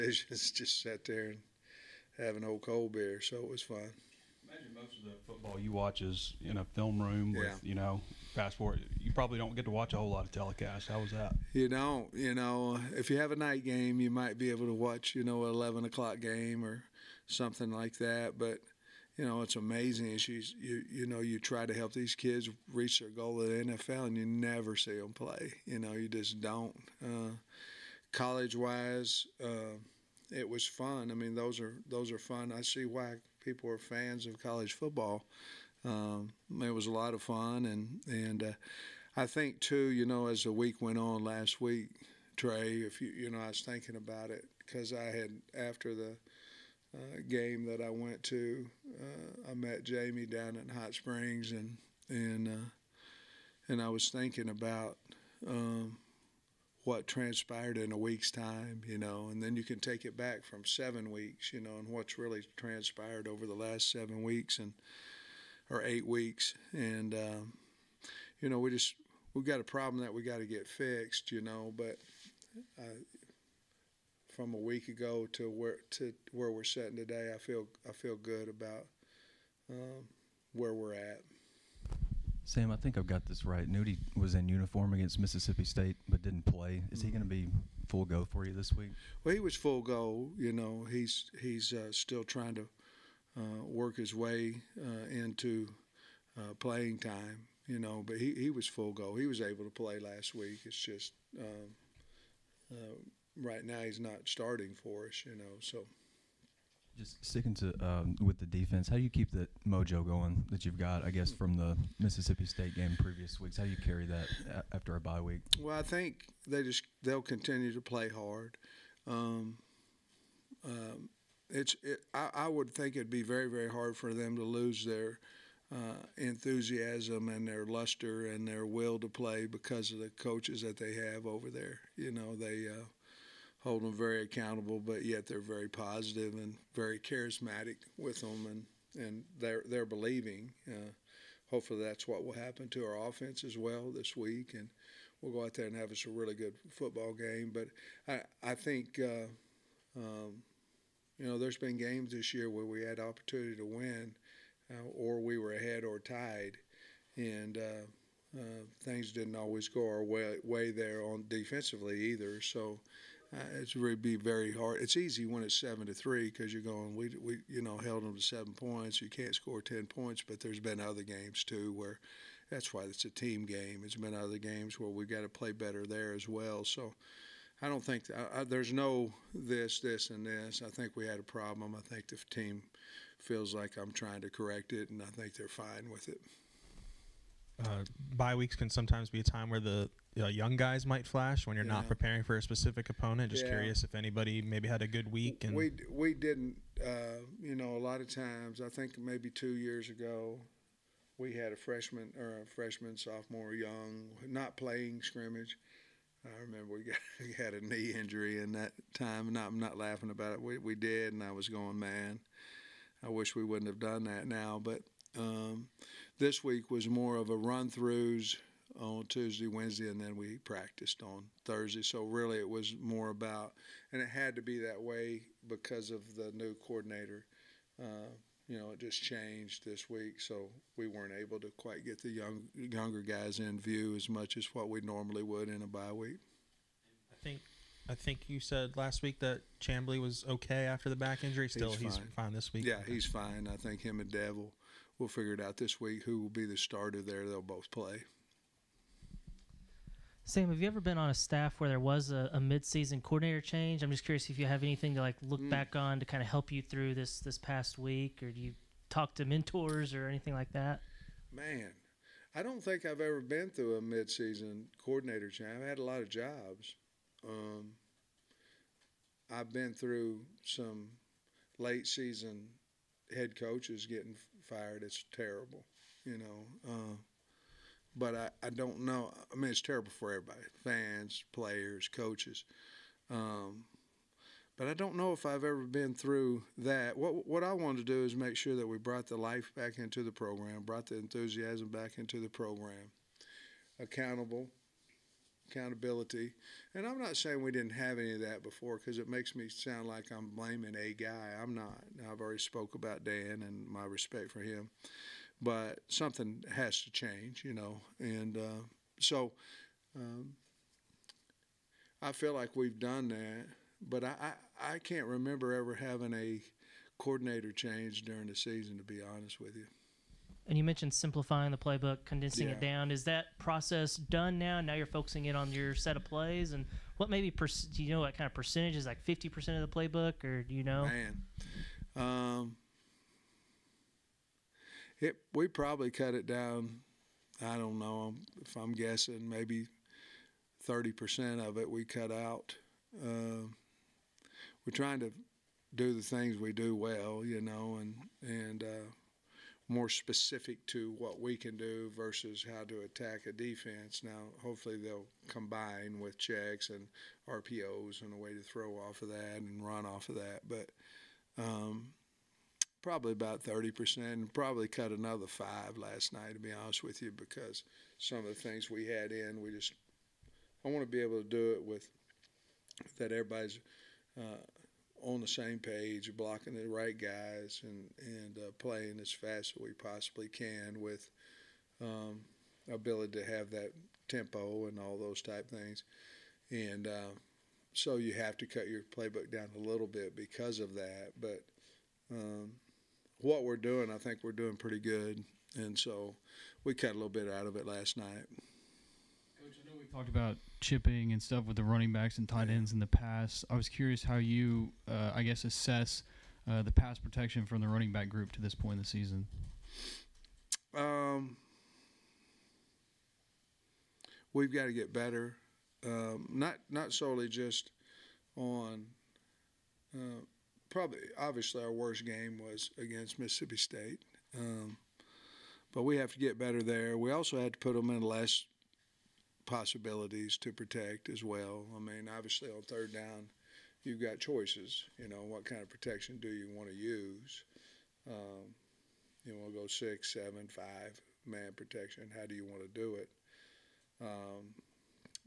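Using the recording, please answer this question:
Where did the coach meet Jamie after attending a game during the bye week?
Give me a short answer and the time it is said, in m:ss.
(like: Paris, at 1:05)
Hot Springs, at 0:50.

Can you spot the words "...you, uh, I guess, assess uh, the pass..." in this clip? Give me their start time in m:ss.
6:44.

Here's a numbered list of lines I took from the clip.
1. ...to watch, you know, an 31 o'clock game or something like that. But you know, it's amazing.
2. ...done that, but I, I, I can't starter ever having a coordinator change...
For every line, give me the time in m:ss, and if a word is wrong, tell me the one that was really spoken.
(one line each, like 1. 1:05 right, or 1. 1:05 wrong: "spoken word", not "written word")
1. 0:14 wrong: "11", not "31"
2. 5:12 wrong: "remember", not "starter".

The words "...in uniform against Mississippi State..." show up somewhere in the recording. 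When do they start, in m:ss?
1:24.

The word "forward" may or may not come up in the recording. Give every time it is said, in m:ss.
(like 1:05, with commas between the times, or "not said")
0:08.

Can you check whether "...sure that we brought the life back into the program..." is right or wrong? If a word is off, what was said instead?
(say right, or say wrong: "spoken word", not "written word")
right.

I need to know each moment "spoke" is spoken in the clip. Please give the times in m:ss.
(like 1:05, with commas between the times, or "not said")
5:02.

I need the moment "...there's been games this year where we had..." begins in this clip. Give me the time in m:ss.
2:31.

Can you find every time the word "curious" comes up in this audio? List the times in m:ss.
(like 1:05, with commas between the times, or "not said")
3:13, 4:14, 6:43.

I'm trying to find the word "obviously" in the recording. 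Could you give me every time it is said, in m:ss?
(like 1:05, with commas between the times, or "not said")
7:01, 7:12.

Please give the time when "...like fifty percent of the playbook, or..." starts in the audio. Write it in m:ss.
5:28.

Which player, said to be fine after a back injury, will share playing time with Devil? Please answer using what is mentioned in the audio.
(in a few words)
Chamblee.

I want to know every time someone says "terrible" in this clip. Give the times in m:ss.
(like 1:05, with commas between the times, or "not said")
4:35, 4:39.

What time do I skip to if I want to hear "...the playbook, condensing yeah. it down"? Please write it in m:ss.
5:21.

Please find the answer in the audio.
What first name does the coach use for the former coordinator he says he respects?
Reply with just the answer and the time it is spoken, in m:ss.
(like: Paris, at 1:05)
Dan, at 5:03.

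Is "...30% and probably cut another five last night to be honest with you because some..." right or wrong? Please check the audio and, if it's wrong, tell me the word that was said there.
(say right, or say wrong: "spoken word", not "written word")
right.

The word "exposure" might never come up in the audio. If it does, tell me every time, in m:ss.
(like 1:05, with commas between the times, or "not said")
not said.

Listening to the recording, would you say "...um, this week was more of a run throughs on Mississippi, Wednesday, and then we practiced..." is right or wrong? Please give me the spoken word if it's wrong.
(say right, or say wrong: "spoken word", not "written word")
wrong: "Tuesday", not "Mississippi".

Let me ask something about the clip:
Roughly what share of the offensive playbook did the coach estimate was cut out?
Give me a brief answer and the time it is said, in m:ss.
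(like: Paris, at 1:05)
30%, at 5:40.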